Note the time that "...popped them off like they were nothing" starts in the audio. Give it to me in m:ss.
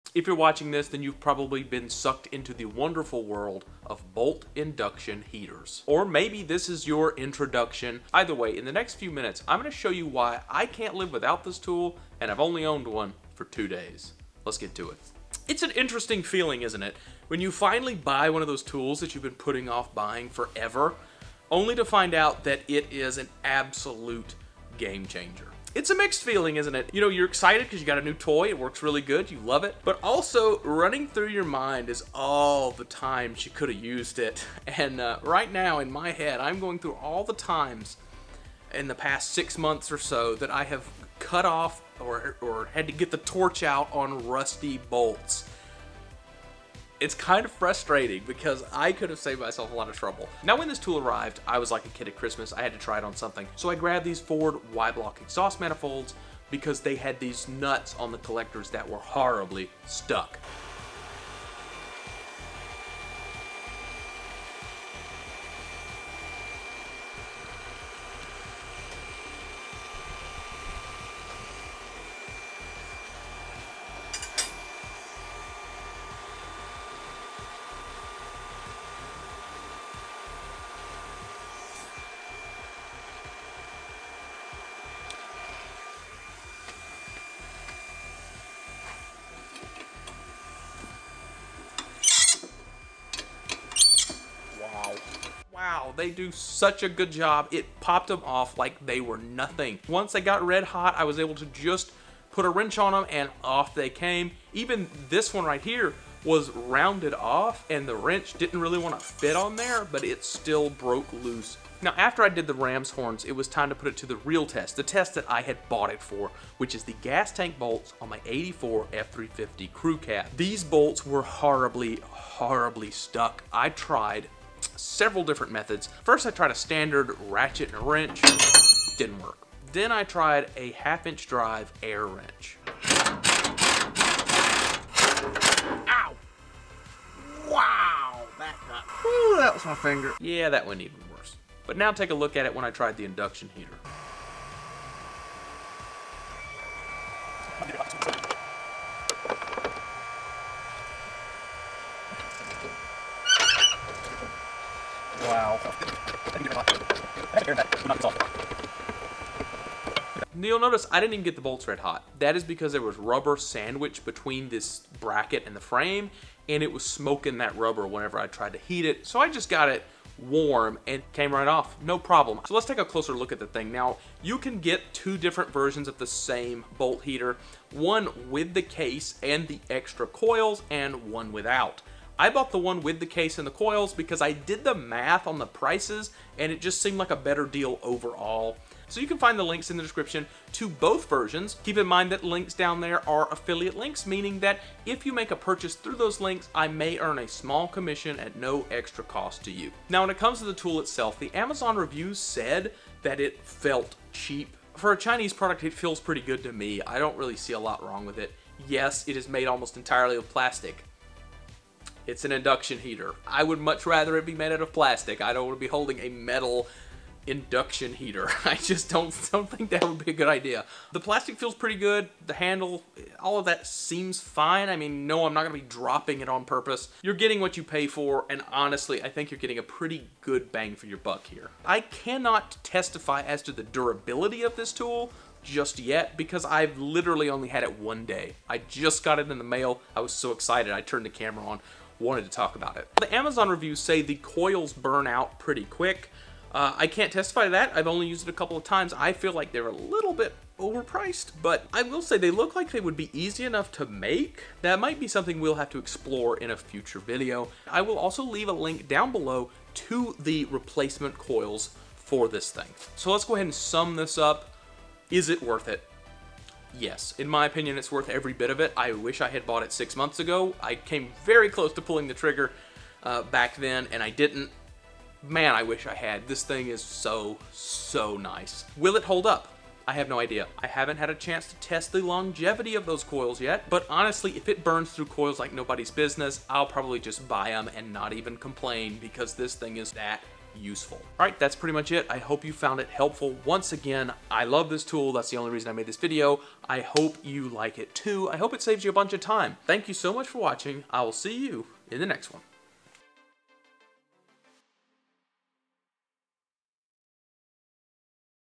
1:37.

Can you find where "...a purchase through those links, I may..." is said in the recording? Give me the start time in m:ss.
3:15.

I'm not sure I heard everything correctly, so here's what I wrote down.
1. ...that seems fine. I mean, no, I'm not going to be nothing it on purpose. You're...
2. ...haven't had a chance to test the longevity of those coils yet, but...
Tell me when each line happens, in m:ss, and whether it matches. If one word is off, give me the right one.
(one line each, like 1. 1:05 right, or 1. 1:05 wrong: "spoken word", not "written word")
1. 3:43 wrong: "dropping", not "nothing"
2. 4:40 right.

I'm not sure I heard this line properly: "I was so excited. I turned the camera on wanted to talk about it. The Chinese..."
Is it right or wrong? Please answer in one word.
wrong.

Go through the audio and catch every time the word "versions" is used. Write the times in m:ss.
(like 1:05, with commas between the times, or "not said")
2:55, 3:11.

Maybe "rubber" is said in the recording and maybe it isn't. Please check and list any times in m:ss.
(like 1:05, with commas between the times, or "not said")
2:42, 2:47.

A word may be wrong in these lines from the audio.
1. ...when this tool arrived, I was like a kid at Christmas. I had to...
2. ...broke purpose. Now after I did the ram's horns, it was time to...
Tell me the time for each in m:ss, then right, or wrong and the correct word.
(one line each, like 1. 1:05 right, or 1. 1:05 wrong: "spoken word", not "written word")
1. 0:50 right
2. 1:50 wrong: "loose", not "purpose".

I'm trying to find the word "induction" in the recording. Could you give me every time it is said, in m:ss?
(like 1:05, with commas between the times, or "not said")
0:04, 2:23, 3:32, 3:37.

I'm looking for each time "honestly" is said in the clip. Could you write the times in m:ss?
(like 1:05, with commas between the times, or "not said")
3:48, 4:43.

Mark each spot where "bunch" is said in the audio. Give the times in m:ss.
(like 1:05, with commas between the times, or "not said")
4:58.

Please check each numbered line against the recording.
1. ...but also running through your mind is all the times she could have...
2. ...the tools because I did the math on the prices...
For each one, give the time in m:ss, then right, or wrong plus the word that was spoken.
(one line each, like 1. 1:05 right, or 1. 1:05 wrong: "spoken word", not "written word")
1. 0:29 right
2. 3:03 wrong: "coils", not "tools".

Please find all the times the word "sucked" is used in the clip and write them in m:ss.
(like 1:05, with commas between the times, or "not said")
0:01.